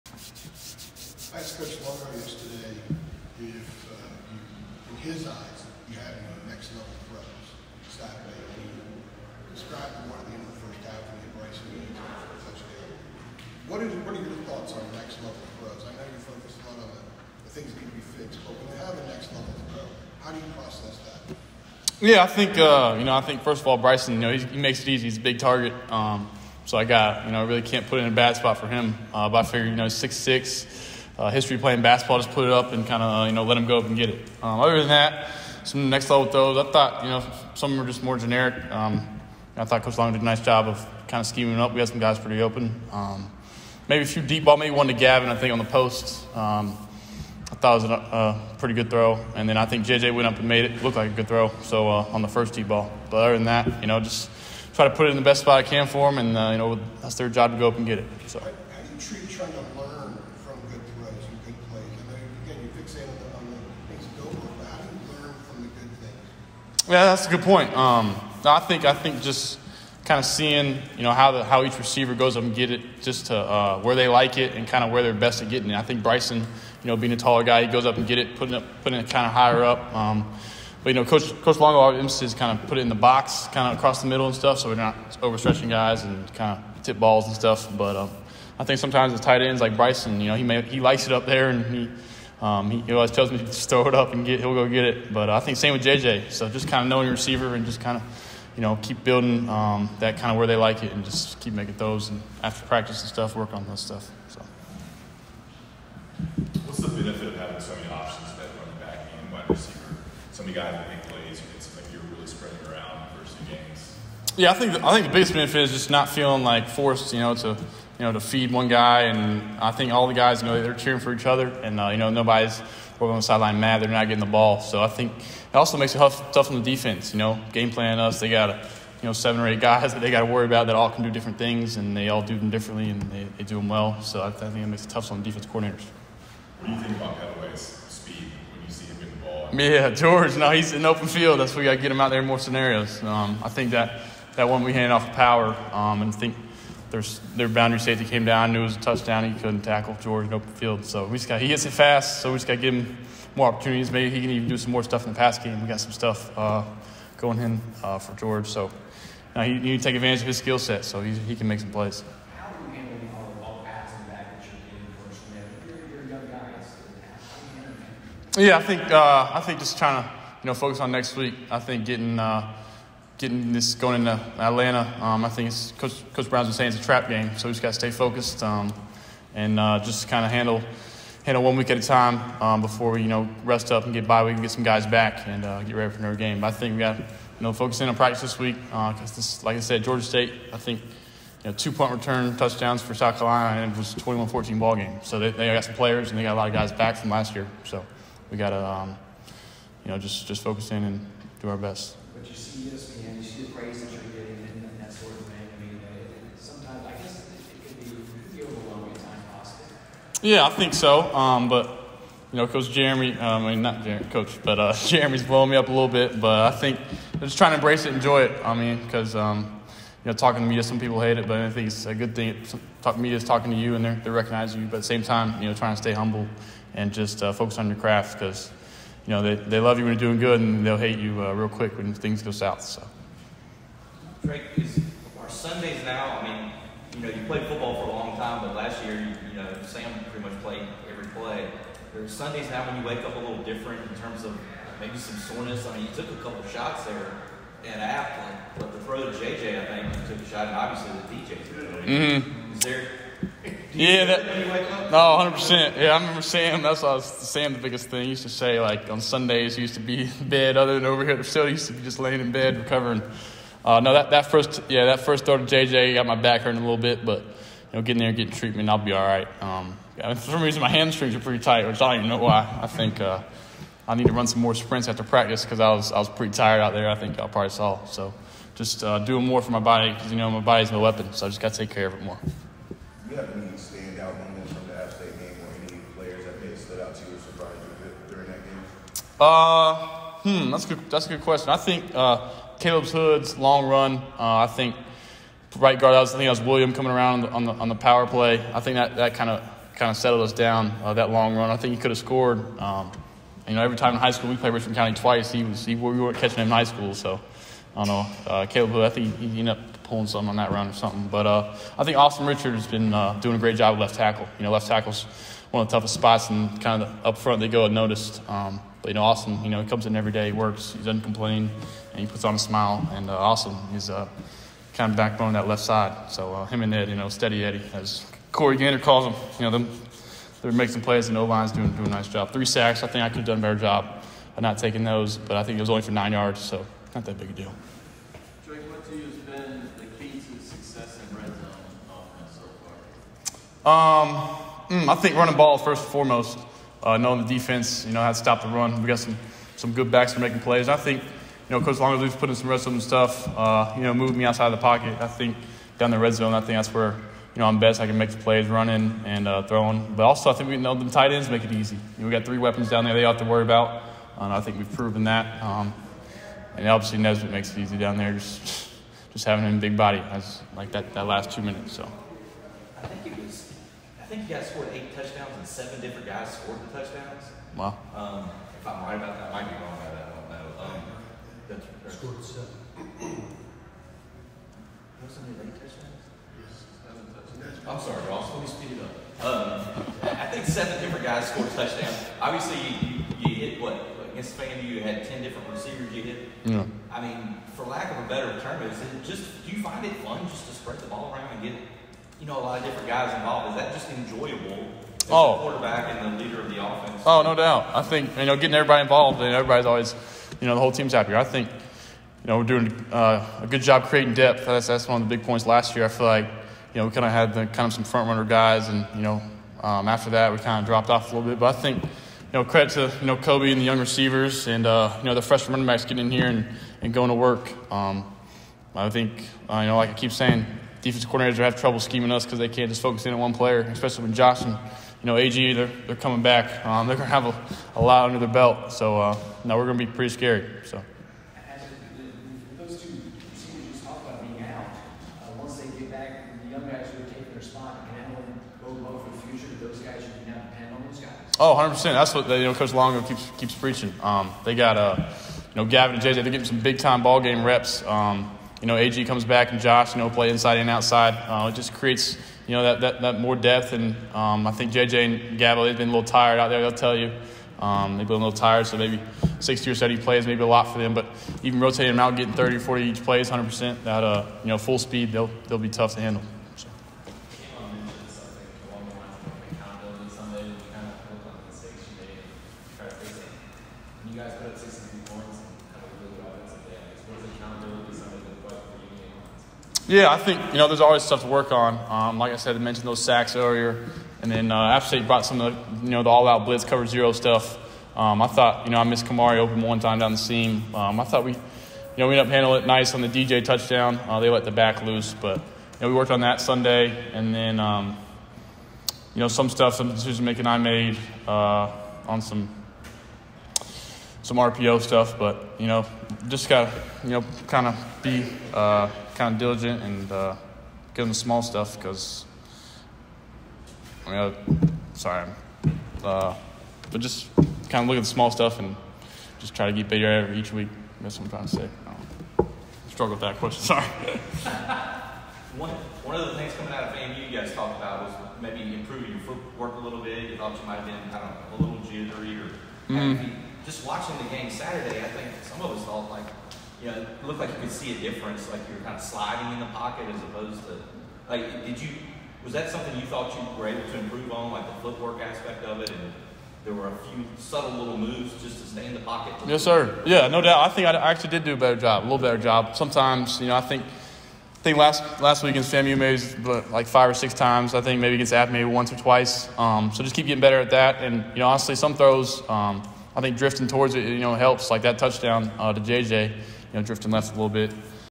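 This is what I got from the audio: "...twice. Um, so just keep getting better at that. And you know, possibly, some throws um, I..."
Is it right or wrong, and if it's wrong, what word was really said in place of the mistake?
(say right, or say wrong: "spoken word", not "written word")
wrong: "honestly", not "possibly".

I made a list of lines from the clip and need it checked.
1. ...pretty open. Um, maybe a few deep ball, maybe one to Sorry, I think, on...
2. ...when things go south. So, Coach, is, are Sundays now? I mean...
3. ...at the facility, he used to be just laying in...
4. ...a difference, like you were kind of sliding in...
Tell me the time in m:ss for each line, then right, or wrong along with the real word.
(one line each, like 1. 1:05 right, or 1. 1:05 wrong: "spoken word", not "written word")
1. 0:42 wrong: "Gavin", not "Sorry"
2. 3:51 wrong: "Drake", not "Coach"
3. 4:21 right
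4. 9:07 right.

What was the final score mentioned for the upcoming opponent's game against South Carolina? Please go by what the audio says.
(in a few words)
21-14.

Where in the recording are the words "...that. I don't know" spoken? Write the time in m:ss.
6:19.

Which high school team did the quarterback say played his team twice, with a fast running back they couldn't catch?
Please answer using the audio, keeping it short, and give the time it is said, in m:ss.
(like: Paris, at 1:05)
Richmond County, at 5:04.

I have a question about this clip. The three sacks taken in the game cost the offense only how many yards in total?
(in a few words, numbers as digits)
9.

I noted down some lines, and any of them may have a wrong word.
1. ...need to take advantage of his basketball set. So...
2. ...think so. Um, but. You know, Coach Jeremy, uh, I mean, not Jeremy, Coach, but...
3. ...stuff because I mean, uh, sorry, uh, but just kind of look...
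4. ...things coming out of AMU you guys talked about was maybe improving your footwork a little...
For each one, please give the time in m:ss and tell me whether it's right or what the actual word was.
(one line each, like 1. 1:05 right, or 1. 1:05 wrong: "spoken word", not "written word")
1. 2:39 wrong: "skill", not "basketball"
2. 3:30 right
3. 8:41 right
4. 8:56 right.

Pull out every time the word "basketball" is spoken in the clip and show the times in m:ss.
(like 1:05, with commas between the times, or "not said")
0:31.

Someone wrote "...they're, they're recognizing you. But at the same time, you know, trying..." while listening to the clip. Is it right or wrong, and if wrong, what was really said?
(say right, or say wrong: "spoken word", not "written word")
right.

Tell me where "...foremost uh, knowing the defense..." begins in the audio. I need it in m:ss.
5:45.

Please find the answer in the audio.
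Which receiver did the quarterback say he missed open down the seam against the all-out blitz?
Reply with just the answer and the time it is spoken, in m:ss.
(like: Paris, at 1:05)
Kamari, at 8:19.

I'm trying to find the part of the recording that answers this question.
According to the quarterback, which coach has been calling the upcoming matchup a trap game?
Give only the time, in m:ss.
2:56.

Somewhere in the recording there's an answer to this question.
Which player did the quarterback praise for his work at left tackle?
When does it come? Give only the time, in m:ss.
5:11.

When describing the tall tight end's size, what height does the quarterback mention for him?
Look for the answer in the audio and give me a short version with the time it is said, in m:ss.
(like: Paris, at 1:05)
6'6", at 0:29.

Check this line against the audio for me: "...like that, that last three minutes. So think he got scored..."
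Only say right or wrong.
wrong.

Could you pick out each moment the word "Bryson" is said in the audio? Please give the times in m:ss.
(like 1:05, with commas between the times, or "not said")
0:23, 1:16, 1:29.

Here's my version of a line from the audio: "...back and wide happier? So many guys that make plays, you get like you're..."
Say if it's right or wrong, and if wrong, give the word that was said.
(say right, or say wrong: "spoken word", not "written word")
wrong: "receiver", not "happier".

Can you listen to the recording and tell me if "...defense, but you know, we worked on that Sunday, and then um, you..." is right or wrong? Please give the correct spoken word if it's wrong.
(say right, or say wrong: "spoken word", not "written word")
wrong: "loose", not "defense".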